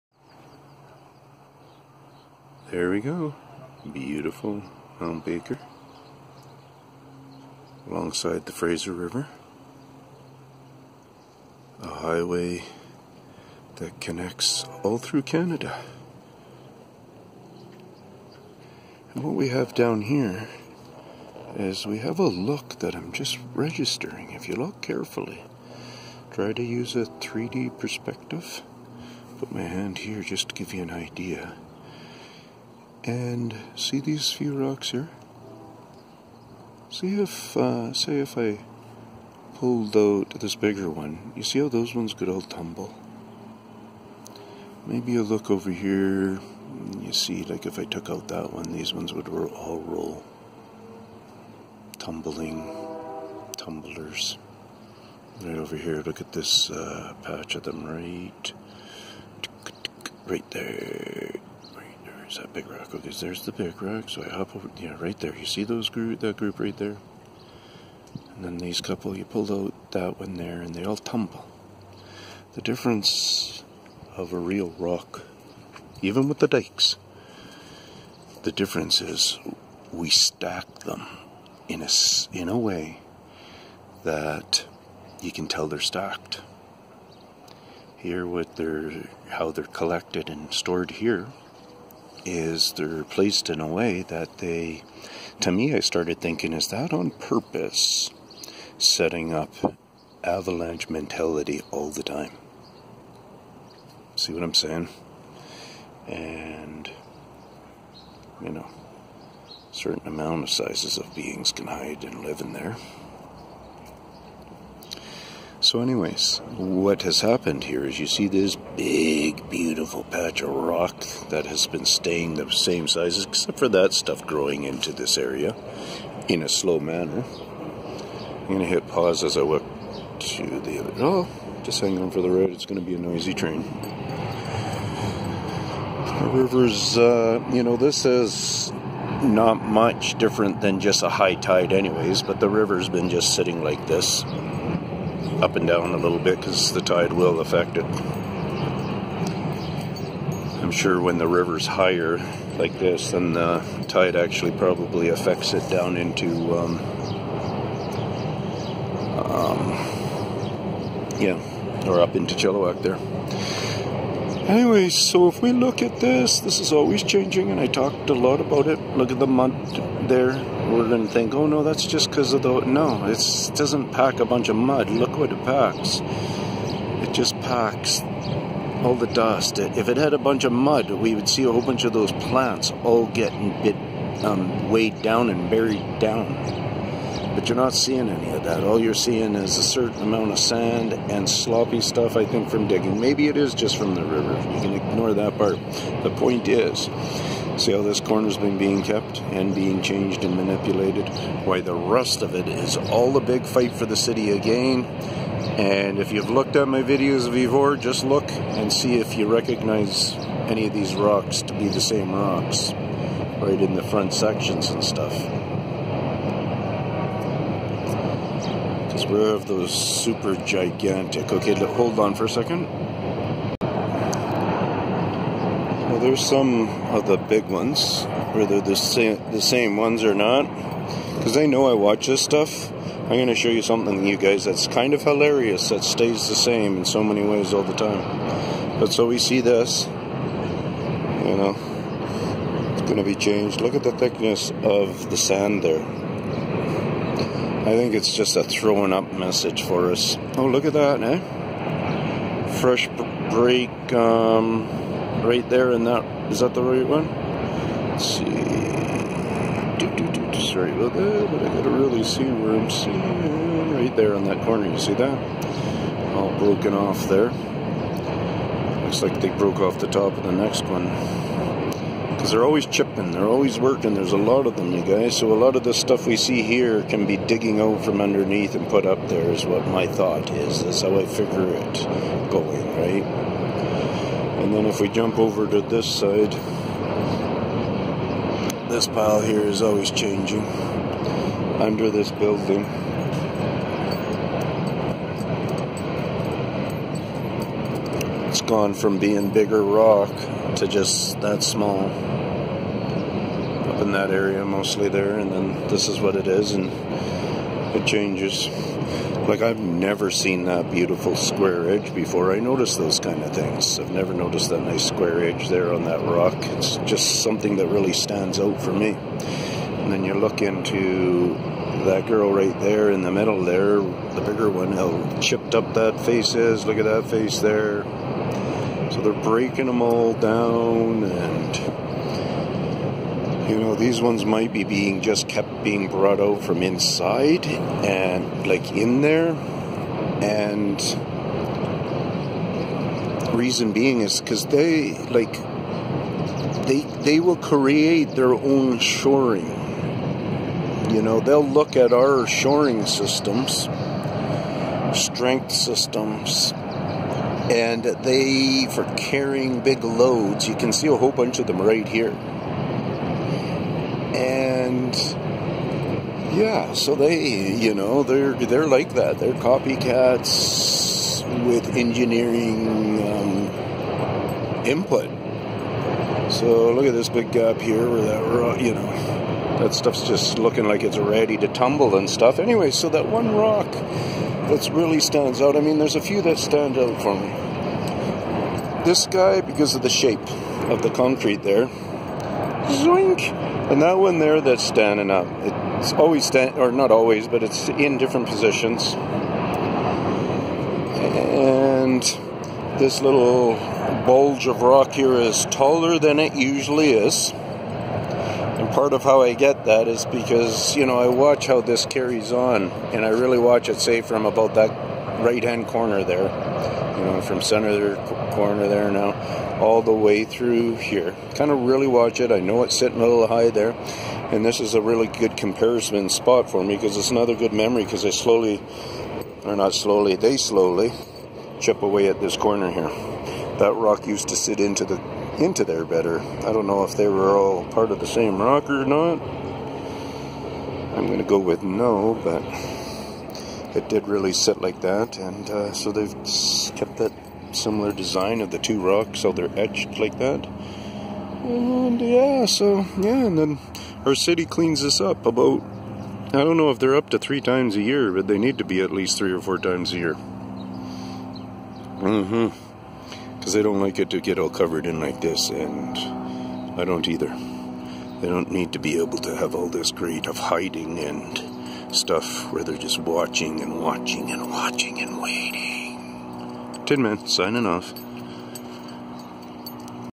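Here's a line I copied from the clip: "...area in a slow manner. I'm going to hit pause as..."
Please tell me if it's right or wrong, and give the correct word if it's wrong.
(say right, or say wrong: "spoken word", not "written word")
right.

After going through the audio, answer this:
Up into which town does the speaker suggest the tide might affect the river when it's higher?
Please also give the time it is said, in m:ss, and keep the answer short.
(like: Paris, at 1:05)
Chilliwack, at 2:42.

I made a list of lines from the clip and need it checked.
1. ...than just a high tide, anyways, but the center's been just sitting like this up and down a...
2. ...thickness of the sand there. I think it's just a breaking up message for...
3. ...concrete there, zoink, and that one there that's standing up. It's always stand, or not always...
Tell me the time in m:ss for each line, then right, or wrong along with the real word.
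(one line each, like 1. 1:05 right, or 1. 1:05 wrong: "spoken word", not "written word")
1. 2:20 wrong: "river", not "center"
2. 4:03 wrong: "throwing", not "breaking"
3. 6:30 right.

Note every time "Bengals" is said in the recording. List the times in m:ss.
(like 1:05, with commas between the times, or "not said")
not said.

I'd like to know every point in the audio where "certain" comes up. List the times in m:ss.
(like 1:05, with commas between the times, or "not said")
1:49, 3:09.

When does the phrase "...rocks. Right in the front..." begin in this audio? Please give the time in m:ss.
3:32.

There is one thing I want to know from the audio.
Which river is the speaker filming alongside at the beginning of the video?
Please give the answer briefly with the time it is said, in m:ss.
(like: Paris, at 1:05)
Fraser River, at 0:08.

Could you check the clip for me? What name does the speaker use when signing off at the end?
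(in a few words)
Tin Man.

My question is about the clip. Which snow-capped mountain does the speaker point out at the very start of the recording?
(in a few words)
Mount Baker.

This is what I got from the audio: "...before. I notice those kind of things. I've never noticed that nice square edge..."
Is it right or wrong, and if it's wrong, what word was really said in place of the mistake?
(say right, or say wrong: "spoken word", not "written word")
right.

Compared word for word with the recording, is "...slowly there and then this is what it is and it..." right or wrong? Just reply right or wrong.
wrong.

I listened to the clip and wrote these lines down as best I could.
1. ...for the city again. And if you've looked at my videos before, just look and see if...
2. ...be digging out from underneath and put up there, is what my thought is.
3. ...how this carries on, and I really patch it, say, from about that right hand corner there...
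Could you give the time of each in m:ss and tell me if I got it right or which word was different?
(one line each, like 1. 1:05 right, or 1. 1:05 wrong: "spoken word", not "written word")
1. 3:23 right
2. 4:37 right
3. 6:51 wrong: "watch", not "patch".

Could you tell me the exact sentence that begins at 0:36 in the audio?
See if, uh, say, if I pulled out this bigger one, you see how those ones could all tumble.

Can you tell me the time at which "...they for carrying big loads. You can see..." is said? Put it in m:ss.
5:57.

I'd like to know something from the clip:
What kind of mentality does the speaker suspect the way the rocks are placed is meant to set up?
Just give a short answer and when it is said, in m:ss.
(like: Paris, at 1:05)
Avalanche mentality, at 1:40.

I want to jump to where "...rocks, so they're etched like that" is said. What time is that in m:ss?
7:28.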